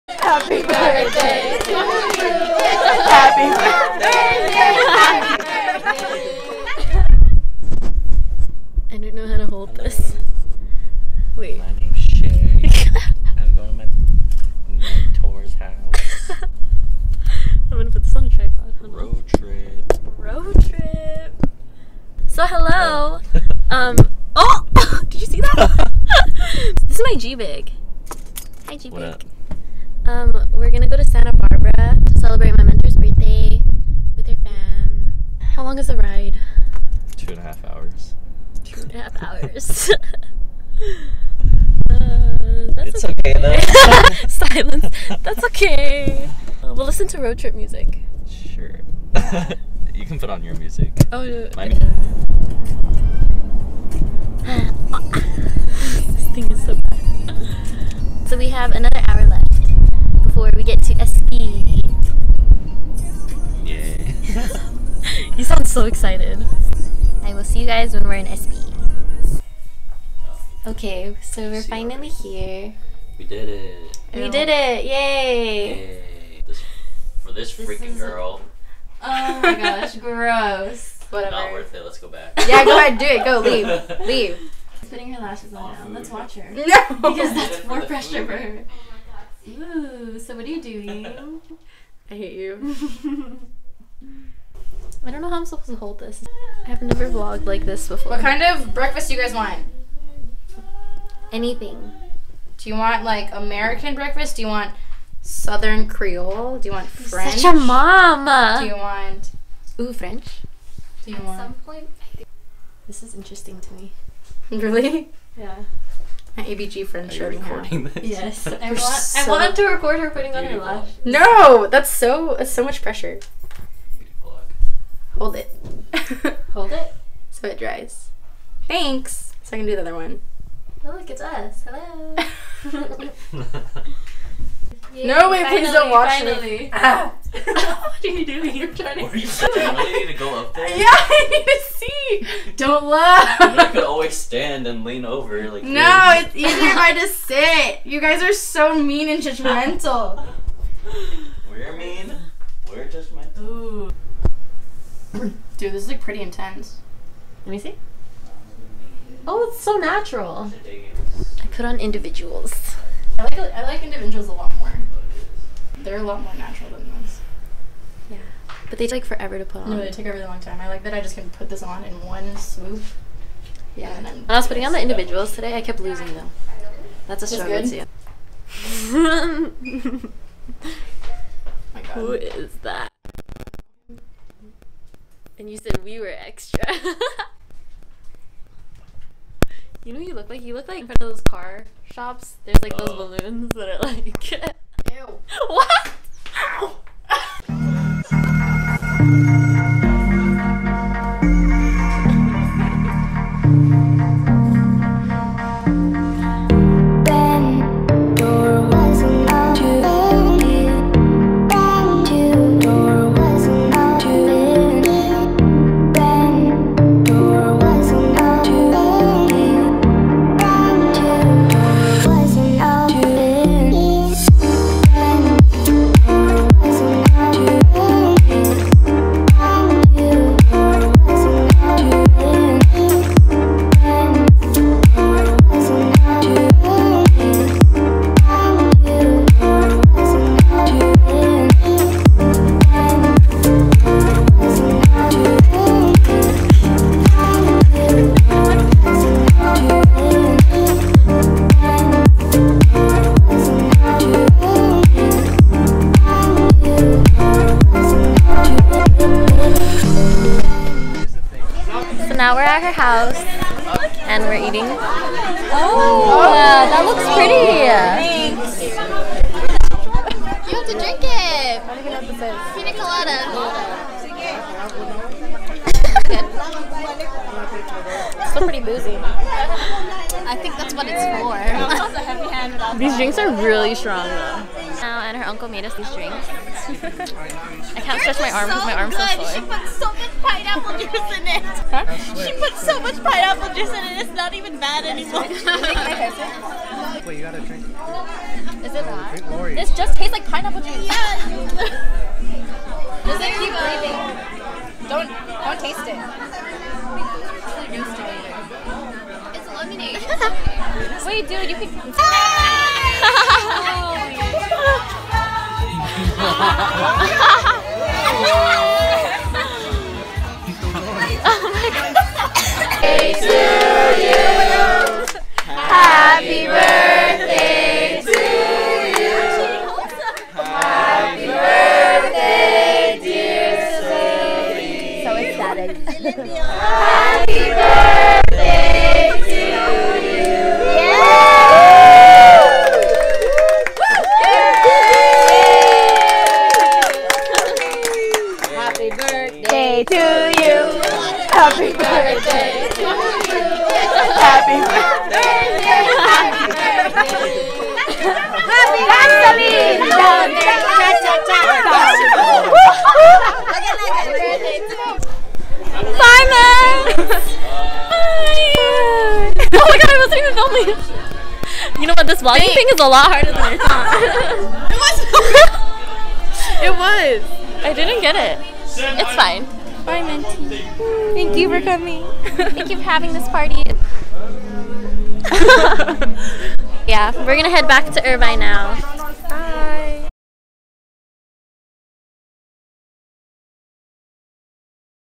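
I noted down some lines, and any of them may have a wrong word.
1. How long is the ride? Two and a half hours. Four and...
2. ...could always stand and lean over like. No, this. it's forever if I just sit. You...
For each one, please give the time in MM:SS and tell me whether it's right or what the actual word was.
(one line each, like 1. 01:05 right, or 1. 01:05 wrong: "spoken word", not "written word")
1. 00:35 wrong: "Two", not "Four"
2. 02:23 wrong: "easier", not "forever".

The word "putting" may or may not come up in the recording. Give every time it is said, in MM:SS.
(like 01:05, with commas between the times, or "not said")
01:24, 02:00, 02:54.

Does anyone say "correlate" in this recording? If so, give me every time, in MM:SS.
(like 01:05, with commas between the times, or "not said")
not said.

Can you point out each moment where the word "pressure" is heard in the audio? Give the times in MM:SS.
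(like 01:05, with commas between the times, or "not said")
01:27, 02:02.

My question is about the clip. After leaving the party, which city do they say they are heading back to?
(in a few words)
Irvine.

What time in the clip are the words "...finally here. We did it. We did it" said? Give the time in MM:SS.
01:11.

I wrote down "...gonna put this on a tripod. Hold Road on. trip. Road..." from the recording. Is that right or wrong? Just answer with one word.
right.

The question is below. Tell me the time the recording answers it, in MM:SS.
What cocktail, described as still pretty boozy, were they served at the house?
04:32.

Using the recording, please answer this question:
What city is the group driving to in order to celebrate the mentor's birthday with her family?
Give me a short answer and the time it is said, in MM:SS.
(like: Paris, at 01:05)
Santa Barbara, at 00:31.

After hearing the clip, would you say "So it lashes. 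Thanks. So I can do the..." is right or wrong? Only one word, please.
wrong.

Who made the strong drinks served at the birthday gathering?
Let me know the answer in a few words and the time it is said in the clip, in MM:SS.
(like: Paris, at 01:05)
Her uncle, at 04:45.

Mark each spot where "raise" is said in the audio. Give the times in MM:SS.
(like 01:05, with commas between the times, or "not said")
not said.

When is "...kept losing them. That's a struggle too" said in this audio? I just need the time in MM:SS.
02:55.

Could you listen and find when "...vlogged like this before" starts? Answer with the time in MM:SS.
01:37.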